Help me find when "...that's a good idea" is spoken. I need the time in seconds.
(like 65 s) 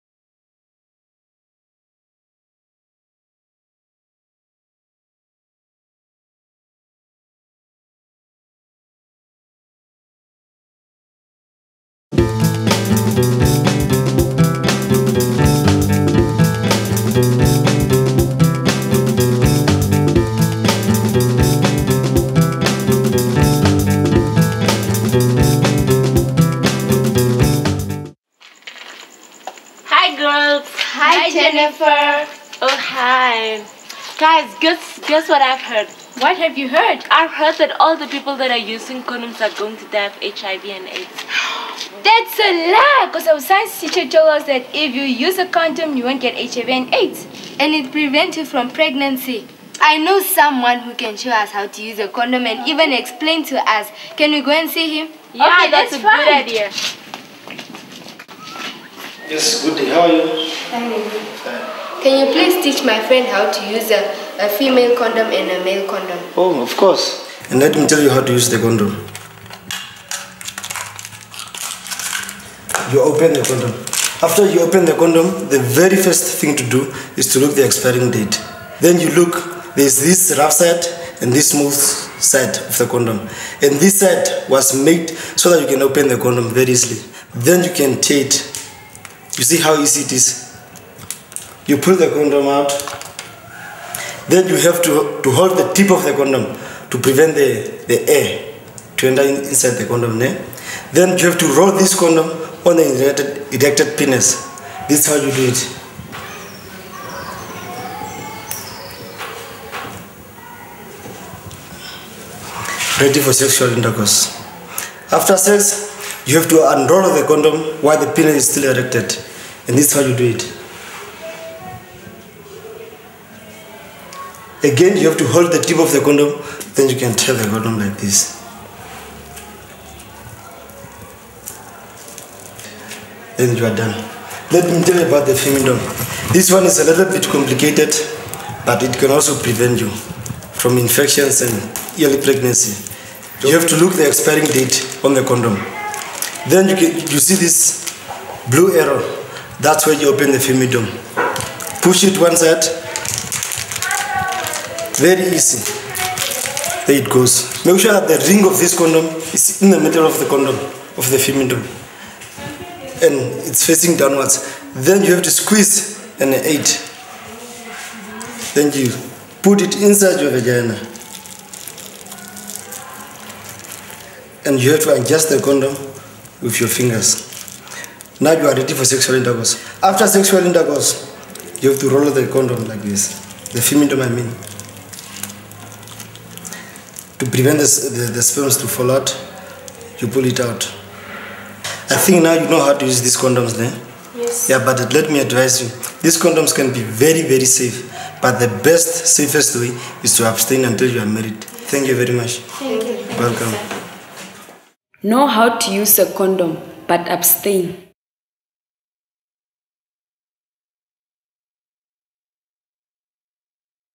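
55 s.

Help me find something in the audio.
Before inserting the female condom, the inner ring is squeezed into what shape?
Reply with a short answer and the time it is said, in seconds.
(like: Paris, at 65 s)
An eight, at 166 s.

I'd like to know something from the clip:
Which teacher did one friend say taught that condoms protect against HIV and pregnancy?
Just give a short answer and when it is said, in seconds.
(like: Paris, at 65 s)
Science teacher, at 43 s.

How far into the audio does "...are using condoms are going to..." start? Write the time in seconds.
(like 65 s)
38 s.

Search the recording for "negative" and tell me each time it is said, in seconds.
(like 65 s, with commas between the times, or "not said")
not said.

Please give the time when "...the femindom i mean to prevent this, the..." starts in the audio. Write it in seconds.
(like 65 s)
183 s.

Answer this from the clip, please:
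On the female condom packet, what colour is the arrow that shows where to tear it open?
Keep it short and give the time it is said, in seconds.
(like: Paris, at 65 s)
Blue, at 148 s.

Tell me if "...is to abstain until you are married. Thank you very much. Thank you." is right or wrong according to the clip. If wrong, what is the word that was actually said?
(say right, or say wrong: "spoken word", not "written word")
right.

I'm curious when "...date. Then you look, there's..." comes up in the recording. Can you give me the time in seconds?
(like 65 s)
78 s.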